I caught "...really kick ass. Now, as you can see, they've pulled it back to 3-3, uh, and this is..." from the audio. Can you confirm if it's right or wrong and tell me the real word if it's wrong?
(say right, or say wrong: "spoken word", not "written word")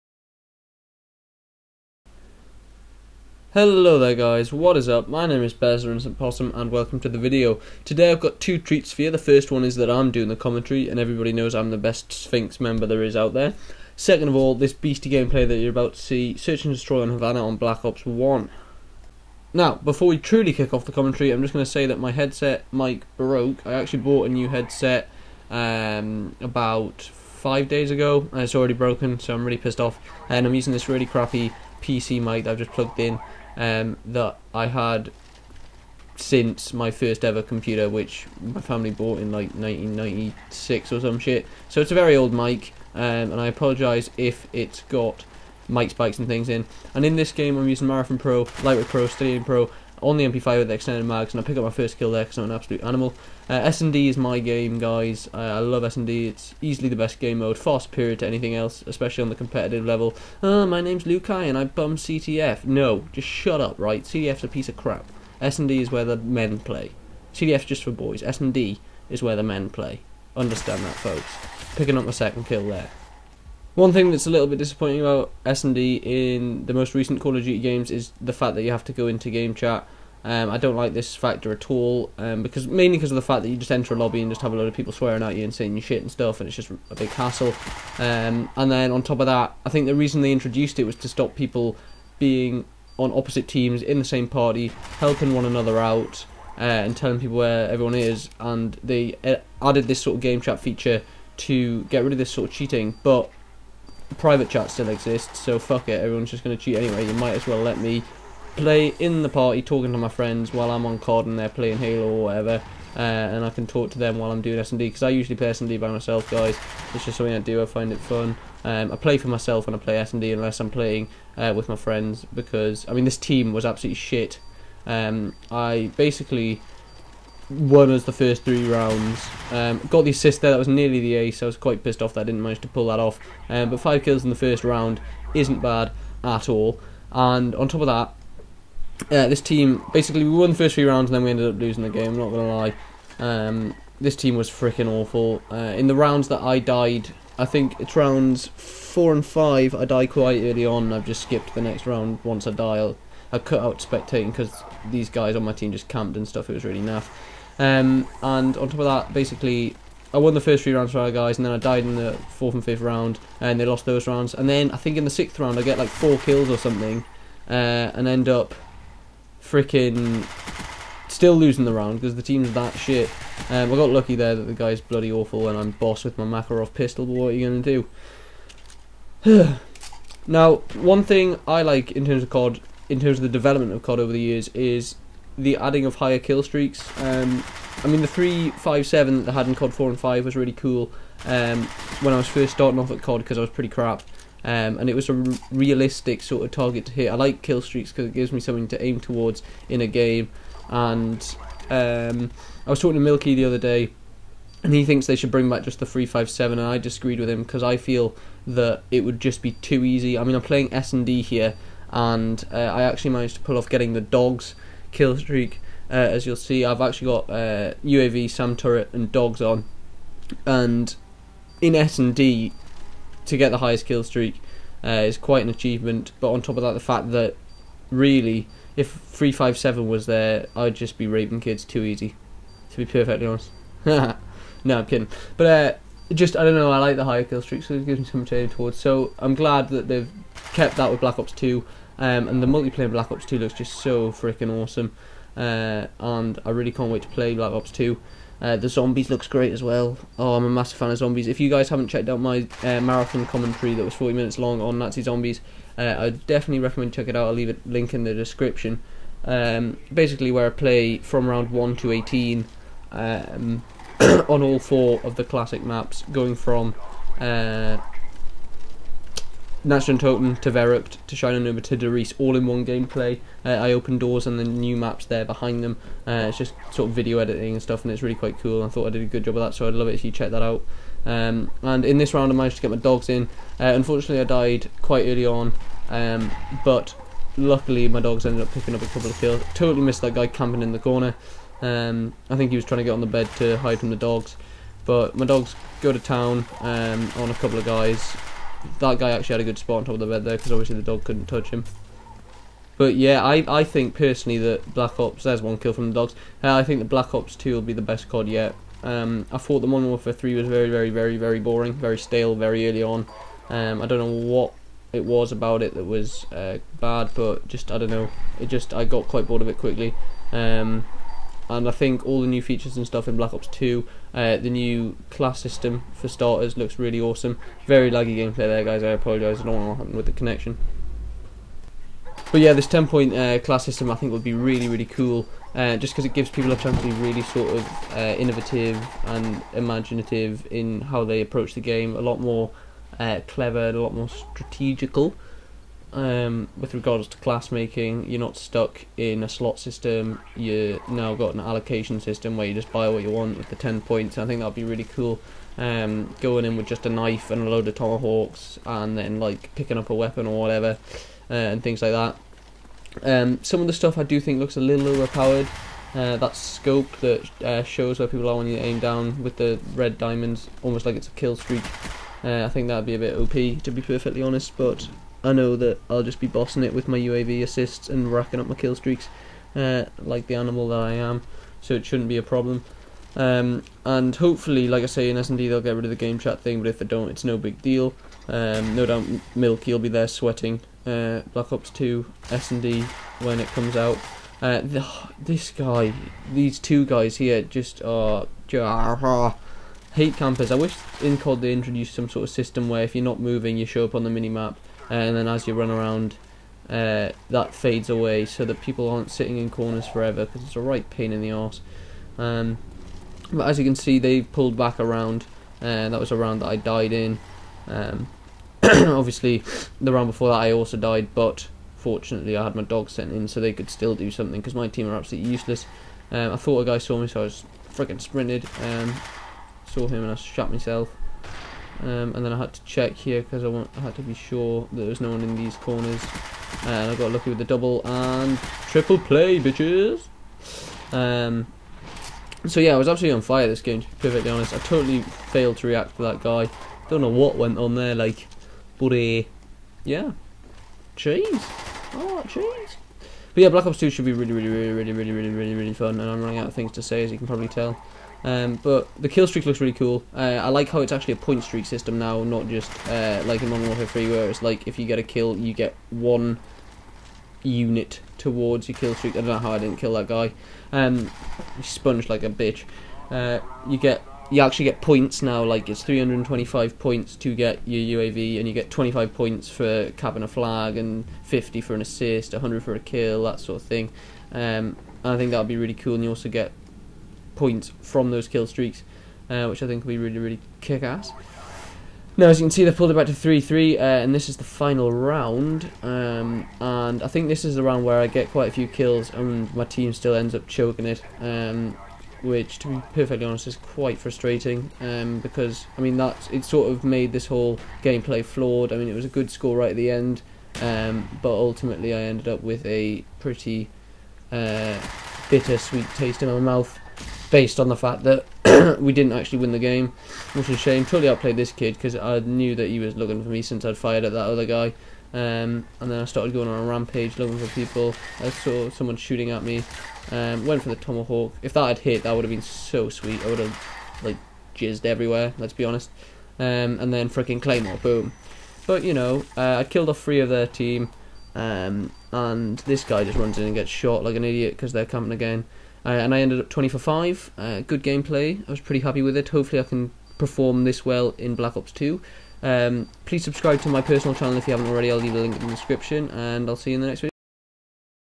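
right.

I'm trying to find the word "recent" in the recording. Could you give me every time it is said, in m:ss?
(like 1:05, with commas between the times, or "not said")
1:16.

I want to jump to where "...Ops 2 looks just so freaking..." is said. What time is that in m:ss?
4:03.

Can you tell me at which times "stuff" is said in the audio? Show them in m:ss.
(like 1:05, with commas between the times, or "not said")
1:26, 2:36, 4:37, 5:22, 6:03.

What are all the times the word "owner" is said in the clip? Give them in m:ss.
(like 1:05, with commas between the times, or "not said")
not said.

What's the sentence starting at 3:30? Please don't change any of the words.
I mean, I'm playing S&D here, and uh, I actually managed to pull off getting the dogs kill streak.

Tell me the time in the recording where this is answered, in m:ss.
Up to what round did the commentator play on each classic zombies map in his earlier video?
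4:21.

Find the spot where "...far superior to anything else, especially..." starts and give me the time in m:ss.
0:57.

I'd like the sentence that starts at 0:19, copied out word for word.
Now, before we truly kick off the commentary, I'm just going to say that my headset mic broke.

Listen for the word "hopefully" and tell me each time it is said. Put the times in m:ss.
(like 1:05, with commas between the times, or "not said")
6:24, 9:09.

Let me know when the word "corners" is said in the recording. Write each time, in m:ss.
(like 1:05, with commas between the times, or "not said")
4:50, 6:49, 7:15.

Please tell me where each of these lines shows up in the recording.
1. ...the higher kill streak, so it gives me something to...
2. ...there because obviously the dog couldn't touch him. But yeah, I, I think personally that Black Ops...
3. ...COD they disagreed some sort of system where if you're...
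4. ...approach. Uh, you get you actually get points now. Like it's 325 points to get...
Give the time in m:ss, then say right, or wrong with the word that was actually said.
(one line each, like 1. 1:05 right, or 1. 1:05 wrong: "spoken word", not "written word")
1. 3:56 right
2. 5:00 right
3. 6:41 wrong: "introduced", not "disagreed"
4. 7:52 wrong: "bitch", not "approach".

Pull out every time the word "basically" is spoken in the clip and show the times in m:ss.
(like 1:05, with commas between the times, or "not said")
2:05, 2:19, 2:39, 4:19.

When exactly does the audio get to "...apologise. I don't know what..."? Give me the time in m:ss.
5:28.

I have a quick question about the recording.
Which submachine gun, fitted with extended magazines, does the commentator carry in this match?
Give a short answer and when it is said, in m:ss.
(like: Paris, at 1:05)
MP5, at 0:50.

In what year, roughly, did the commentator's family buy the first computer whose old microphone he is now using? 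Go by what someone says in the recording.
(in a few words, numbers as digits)
1996.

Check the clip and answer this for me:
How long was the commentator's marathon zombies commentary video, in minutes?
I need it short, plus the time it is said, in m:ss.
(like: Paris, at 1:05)
40, at 4:13.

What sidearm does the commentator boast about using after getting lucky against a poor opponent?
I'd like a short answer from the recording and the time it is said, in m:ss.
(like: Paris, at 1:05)
Makarov, at 2:56.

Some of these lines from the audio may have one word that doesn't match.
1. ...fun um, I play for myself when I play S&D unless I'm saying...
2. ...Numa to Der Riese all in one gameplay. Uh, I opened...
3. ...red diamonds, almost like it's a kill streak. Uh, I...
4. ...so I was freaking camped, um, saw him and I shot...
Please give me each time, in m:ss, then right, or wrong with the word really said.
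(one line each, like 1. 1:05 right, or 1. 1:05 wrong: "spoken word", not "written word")
1. 1:57 wrong: "playing", not "saying"
2. 4:31 right
3. 6:09 right
4. 7:07 wrong: "sprinted", not "camped".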